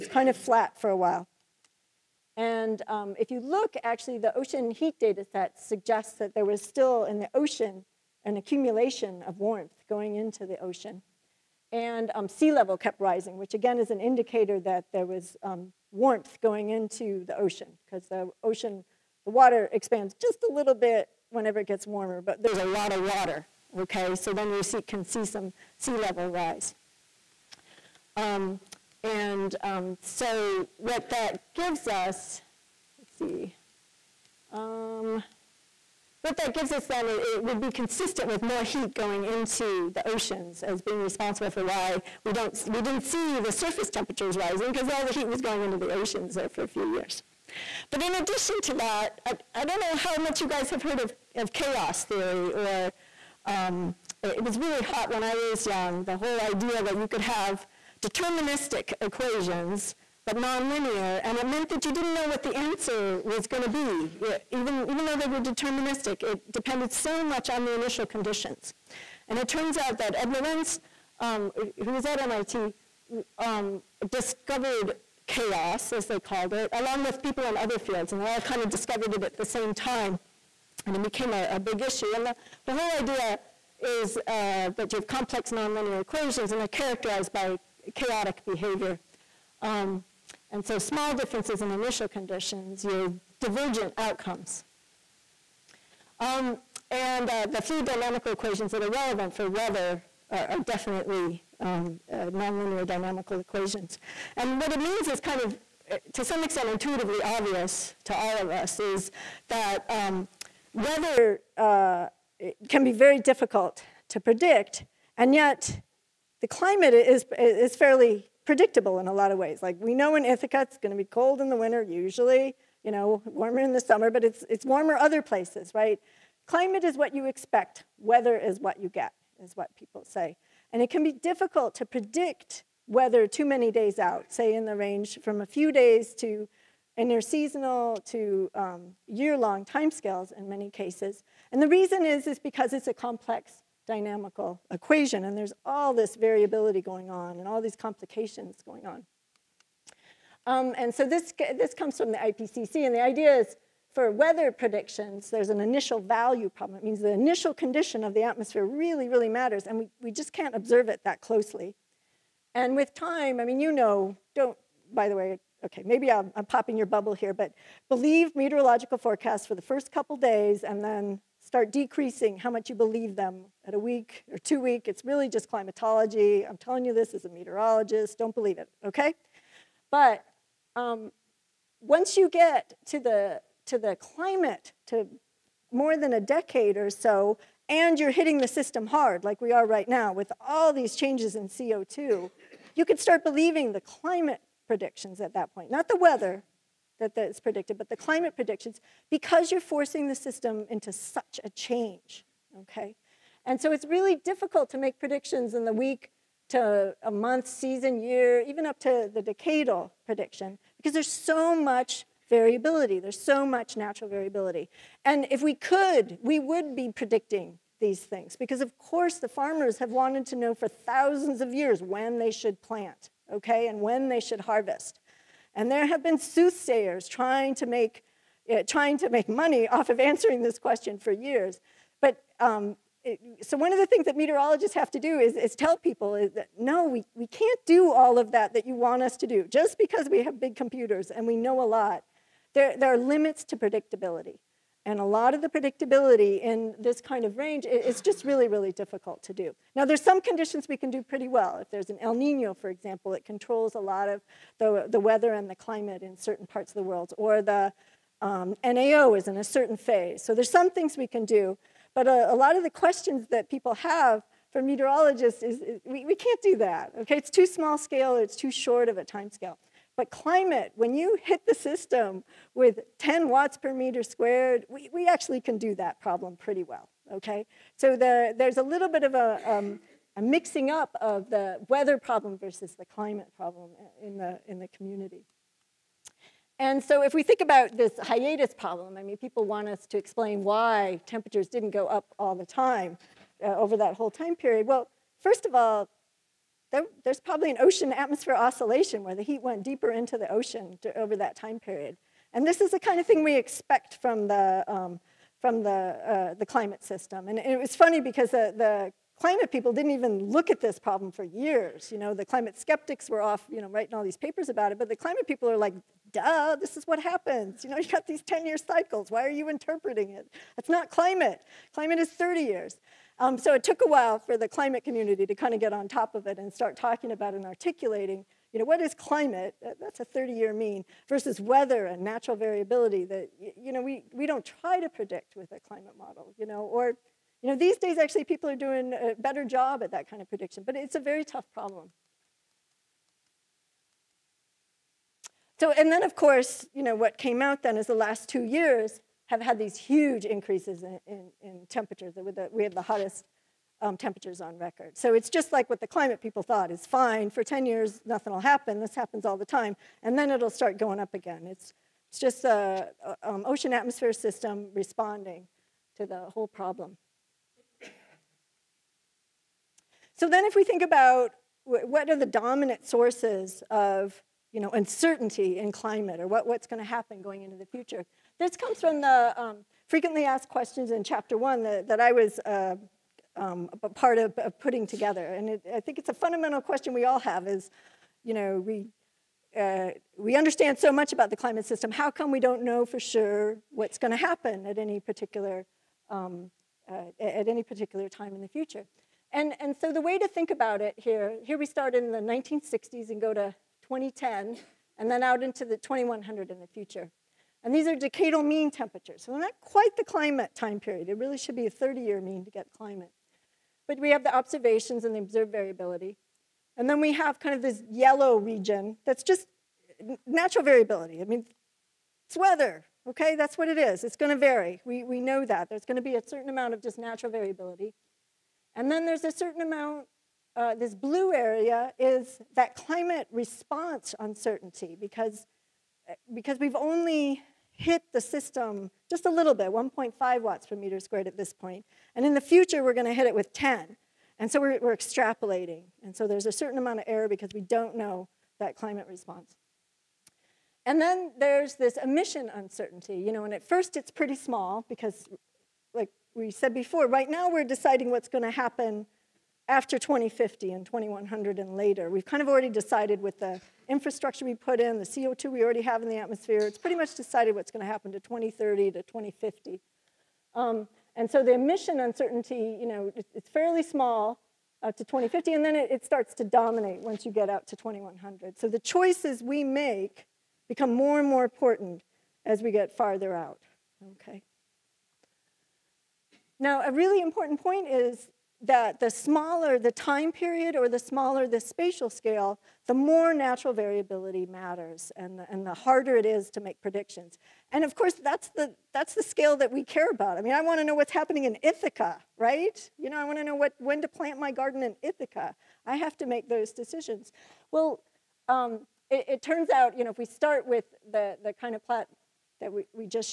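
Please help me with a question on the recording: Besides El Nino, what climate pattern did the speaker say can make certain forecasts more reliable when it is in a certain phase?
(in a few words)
NAO.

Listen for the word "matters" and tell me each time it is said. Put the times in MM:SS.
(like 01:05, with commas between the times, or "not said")
02:39, 08:14.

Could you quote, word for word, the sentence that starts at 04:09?
Now, there's some conditions we can do pretty well.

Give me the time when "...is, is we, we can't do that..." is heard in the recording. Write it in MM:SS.
04:25.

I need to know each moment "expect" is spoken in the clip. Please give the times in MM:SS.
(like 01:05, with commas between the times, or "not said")
02:07, 05:03.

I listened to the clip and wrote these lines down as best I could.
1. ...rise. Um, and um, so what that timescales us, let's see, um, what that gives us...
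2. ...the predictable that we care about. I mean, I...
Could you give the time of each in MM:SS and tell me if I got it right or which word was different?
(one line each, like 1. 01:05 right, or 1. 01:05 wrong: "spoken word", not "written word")
1. 00:26 wrong: "gives", not "timescales"
2. 08:19 wrong: "scale", not "predictable".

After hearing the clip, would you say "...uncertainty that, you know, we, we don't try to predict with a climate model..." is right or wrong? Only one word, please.
wrong.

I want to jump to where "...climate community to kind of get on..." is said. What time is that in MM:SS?
05:24.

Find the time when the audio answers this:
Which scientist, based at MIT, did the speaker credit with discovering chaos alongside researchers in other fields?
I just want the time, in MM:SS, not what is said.
01:10.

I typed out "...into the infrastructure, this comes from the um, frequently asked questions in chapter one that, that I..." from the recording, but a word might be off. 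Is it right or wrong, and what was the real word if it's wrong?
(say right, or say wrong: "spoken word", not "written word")
wrong: "future", not "infrastructure".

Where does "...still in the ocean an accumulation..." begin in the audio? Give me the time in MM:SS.
00:06.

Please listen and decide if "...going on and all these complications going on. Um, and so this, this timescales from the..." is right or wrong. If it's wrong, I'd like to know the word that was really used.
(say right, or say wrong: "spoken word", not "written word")
wrong: "comes", not "timescales".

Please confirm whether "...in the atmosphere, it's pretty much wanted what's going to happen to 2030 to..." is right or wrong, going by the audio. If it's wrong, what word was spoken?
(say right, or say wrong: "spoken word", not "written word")
wrong: "decided", not "wanted".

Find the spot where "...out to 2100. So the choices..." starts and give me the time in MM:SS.
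07:57.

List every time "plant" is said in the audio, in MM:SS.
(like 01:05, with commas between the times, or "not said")
03:42, 08:24.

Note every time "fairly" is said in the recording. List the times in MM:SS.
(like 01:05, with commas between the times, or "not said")
01:57, 07:53.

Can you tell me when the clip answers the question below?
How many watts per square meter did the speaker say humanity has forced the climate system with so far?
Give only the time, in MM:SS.
07:19.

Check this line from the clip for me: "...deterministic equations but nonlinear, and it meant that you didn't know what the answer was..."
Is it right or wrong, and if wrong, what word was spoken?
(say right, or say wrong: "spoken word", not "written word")
right.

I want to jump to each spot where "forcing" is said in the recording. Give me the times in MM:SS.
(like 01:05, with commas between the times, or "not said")
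03:19.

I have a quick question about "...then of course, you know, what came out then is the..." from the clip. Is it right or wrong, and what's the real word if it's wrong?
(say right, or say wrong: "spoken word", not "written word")
right.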